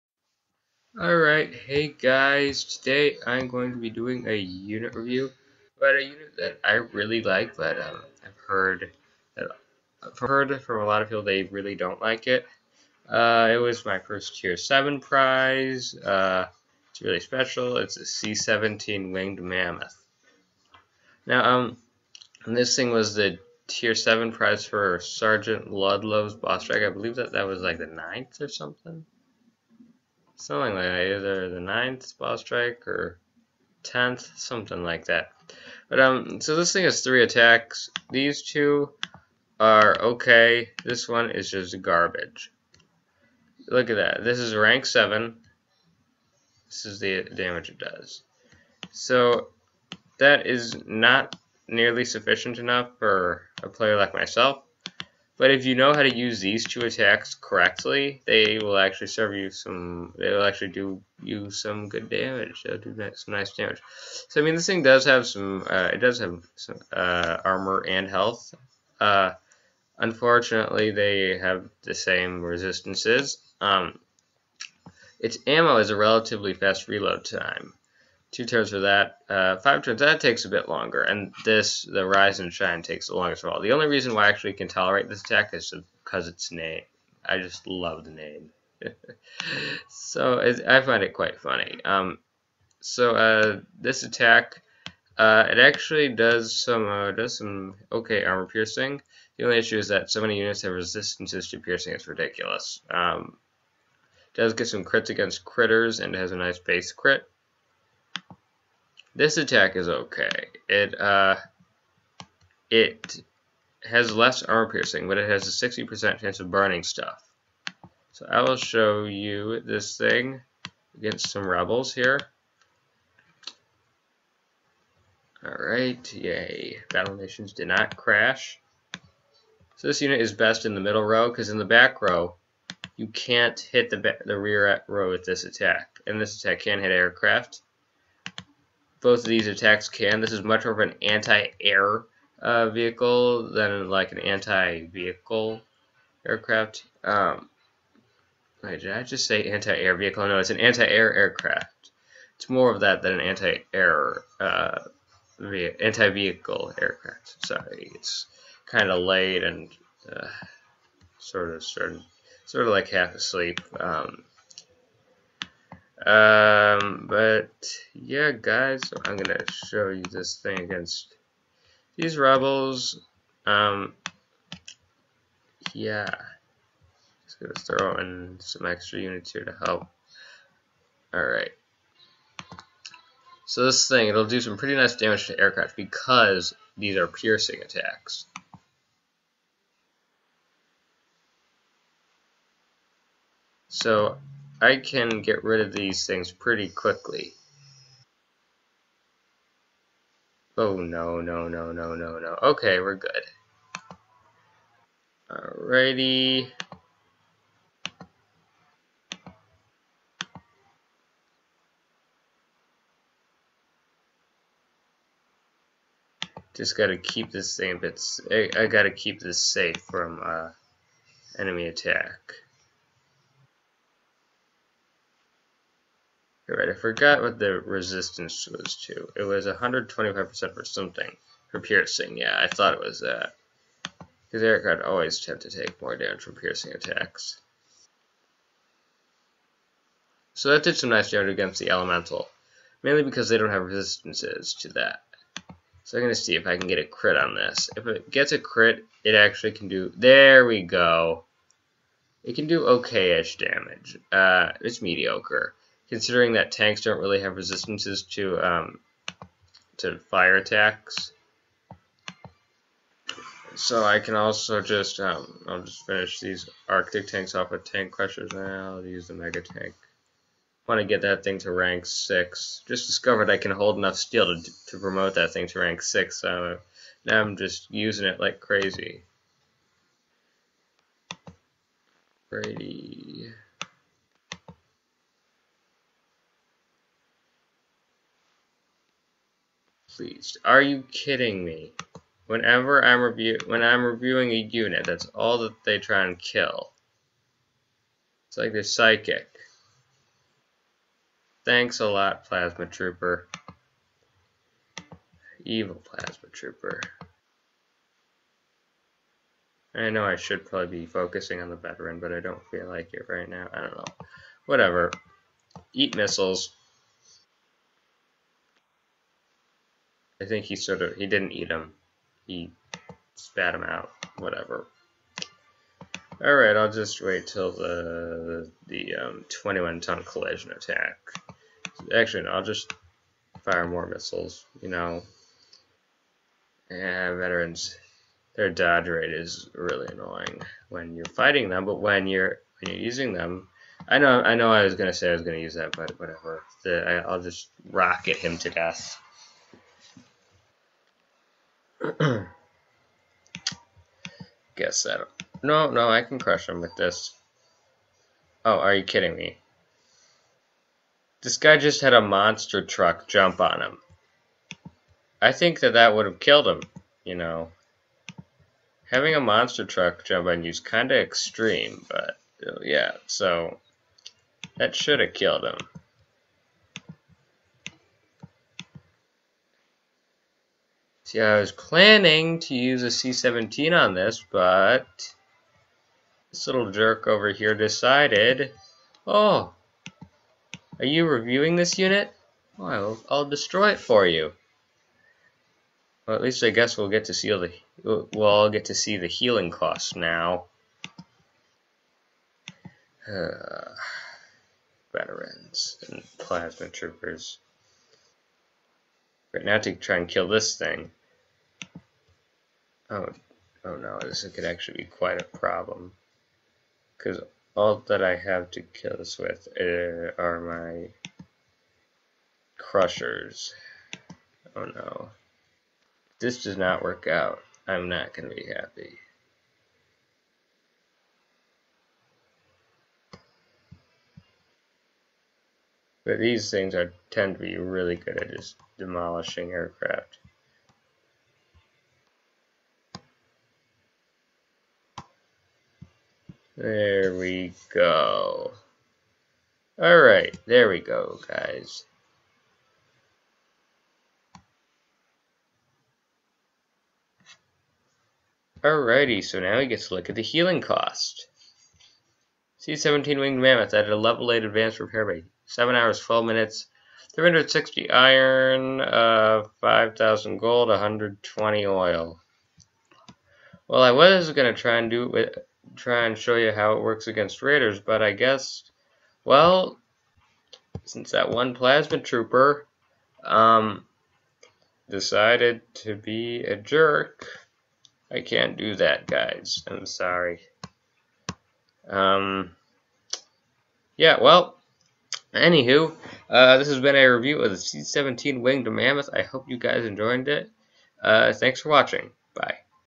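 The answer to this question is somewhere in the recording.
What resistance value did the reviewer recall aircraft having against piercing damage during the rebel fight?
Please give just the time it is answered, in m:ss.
3:49.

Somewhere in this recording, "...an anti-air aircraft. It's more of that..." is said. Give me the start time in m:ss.
2:30.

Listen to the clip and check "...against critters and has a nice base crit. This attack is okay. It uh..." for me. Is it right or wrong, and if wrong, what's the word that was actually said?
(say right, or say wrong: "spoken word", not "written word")
right.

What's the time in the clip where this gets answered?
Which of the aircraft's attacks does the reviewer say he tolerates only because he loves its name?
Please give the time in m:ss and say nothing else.
1:21.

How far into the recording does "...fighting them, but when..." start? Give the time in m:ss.
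5:41.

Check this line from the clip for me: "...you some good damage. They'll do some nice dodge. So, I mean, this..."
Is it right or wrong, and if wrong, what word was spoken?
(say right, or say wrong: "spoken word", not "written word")
wrong: "damage", not "dodge".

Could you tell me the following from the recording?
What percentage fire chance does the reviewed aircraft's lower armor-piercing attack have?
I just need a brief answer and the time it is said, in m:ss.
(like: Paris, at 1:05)
60%, at 1:55.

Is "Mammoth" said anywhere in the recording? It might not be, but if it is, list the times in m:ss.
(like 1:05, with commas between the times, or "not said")
0:19, 7:43, 8:18.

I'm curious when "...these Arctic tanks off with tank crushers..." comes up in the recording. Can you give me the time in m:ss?
4:26.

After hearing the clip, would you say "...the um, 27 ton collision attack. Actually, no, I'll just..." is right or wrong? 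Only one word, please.
wrong.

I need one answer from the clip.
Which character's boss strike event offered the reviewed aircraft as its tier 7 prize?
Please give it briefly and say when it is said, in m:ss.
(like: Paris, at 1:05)
Sergeant Ludlow, at 0:24.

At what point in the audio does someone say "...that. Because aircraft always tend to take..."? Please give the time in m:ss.
3:52.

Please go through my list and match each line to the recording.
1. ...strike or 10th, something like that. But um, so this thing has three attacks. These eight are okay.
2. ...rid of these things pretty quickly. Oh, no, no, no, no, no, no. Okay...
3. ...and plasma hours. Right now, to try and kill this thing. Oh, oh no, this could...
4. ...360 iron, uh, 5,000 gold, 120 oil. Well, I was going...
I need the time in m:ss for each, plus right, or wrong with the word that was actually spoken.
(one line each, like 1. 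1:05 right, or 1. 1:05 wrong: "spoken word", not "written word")
1. 0:32 wrong: "two", not "eight"
2. 3:15 right
3. 6:45 wrong: "troopers", not "hours"
4. 7:47 right.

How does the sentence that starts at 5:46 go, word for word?
The, I, I'll just rocket him to death.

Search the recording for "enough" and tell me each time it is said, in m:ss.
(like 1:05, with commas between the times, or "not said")
0:52, 4:33.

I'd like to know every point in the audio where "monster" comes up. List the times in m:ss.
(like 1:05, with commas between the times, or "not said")
6:02, 6:09.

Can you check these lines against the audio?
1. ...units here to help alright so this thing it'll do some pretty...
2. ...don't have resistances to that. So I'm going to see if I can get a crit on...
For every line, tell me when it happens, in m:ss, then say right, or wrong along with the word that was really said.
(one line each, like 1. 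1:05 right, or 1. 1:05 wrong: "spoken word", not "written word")
1. 2:58 right
2. 4:03 right.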